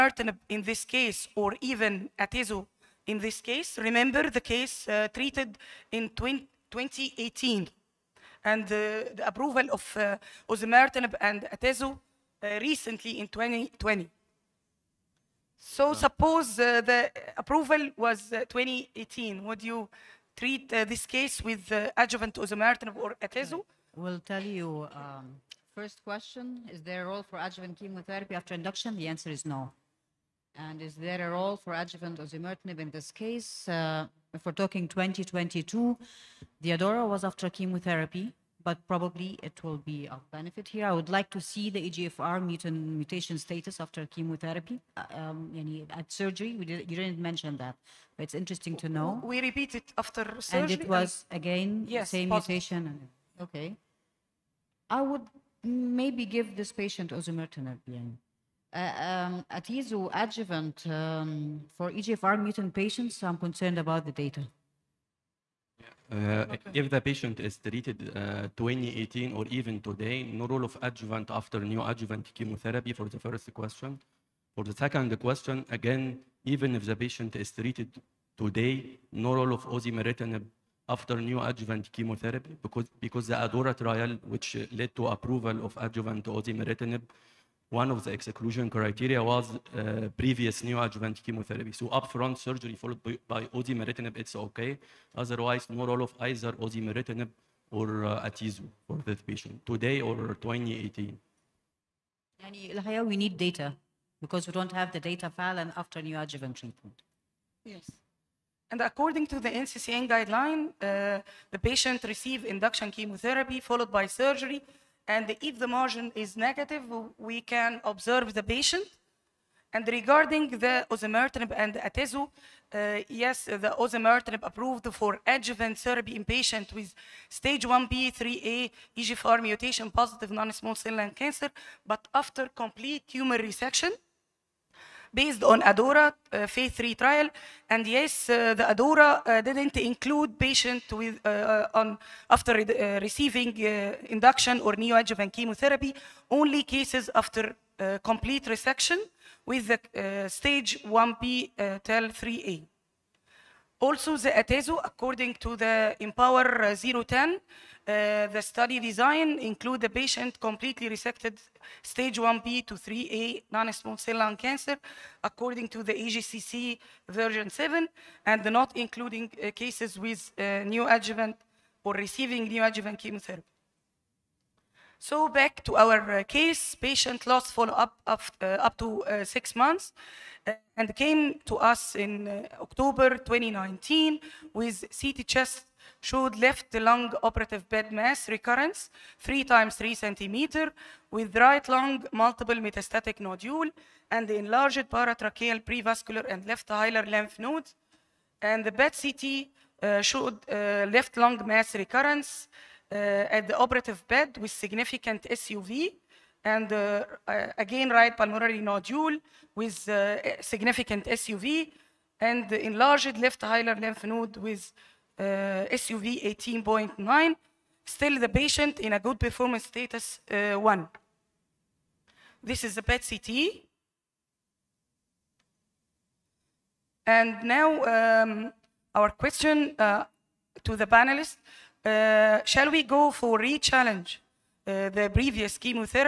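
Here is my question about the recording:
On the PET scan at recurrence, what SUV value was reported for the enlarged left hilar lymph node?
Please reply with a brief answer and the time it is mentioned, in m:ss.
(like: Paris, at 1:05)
18.9, at 3:36.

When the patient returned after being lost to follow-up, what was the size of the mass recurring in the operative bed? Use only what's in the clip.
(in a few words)
3 x 3 cm.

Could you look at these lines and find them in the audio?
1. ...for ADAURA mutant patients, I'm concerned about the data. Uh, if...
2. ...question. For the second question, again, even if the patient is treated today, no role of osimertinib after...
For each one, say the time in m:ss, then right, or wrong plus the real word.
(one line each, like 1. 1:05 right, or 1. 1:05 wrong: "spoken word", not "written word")
1. 1:01 wrong: "EGFR", not "ADAURA"
2. 1:13 right.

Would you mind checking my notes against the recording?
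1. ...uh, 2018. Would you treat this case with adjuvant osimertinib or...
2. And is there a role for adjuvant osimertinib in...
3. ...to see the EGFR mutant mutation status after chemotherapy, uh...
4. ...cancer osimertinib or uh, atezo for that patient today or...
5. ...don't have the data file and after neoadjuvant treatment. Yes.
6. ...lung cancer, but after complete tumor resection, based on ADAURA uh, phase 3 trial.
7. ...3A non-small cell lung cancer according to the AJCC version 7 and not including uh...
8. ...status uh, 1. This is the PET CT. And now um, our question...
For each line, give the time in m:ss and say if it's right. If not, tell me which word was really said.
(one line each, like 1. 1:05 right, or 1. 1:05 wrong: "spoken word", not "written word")
1. 0:18 right
2. 0:30 right
3. 0:41 right
4. 1:36 wrong: "either", not "cancer"
5. 1:44 right
6. 2:10 right
7. 2:42 right
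8. 3:39 right.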